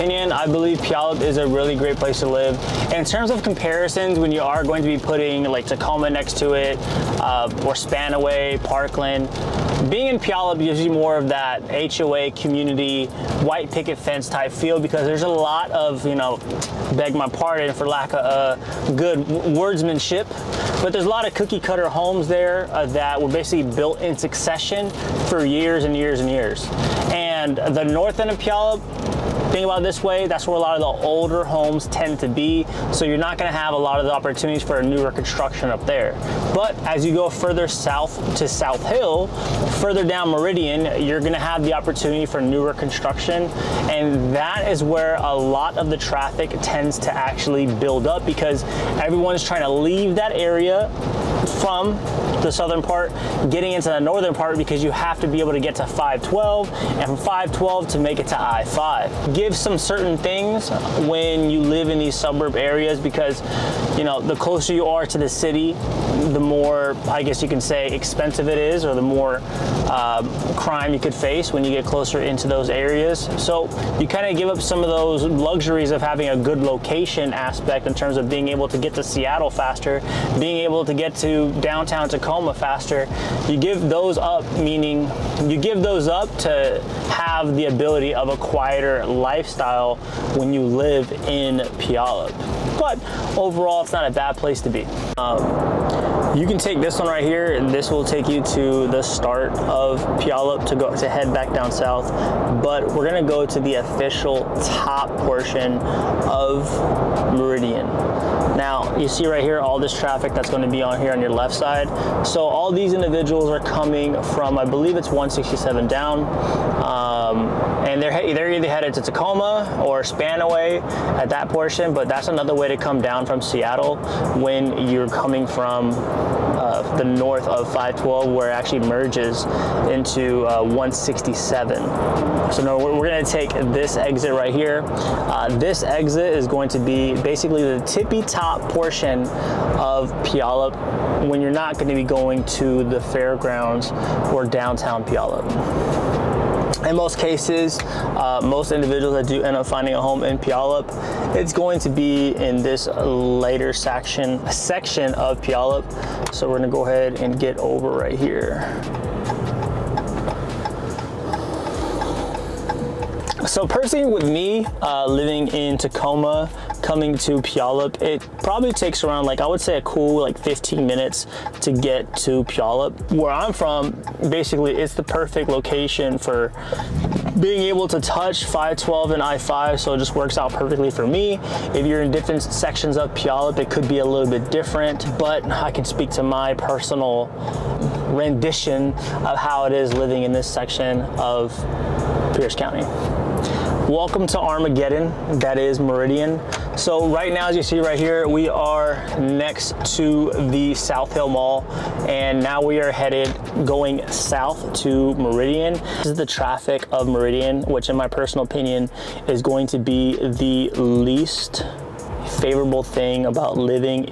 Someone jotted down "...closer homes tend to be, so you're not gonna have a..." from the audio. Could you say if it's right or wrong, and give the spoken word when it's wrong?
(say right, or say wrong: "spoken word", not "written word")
wrong: "older", not "closer".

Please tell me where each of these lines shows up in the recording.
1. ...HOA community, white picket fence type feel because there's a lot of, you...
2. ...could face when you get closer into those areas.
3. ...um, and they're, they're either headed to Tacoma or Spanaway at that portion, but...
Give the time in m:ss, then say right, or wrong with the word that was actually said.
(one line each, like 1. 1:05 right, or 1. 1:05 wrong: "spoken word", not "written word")
1. 0:11 right
2. 1:10 right
3. 1:56 right.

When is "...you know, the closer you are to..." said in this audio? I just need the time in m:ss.
1:03.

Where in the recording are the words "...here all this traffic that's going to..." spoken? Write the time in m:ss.
1:49.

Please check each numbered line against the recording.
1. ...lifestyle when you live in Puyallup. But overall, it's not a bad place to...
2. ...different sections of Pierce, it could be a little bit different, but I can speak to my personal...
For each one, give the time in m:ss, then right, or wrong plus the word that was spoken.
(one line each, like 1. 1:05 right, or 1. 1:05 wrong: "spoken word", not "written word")
1. 1:29 right
2. 3:02 wrong: "Puyallup", not "Pierce".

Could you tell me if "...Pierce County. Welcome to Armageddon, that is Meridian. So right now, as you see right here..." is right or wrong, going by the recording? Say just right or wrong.
right.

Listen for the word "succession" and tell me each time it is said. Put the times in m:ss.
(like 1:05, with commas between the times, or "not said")
0:24.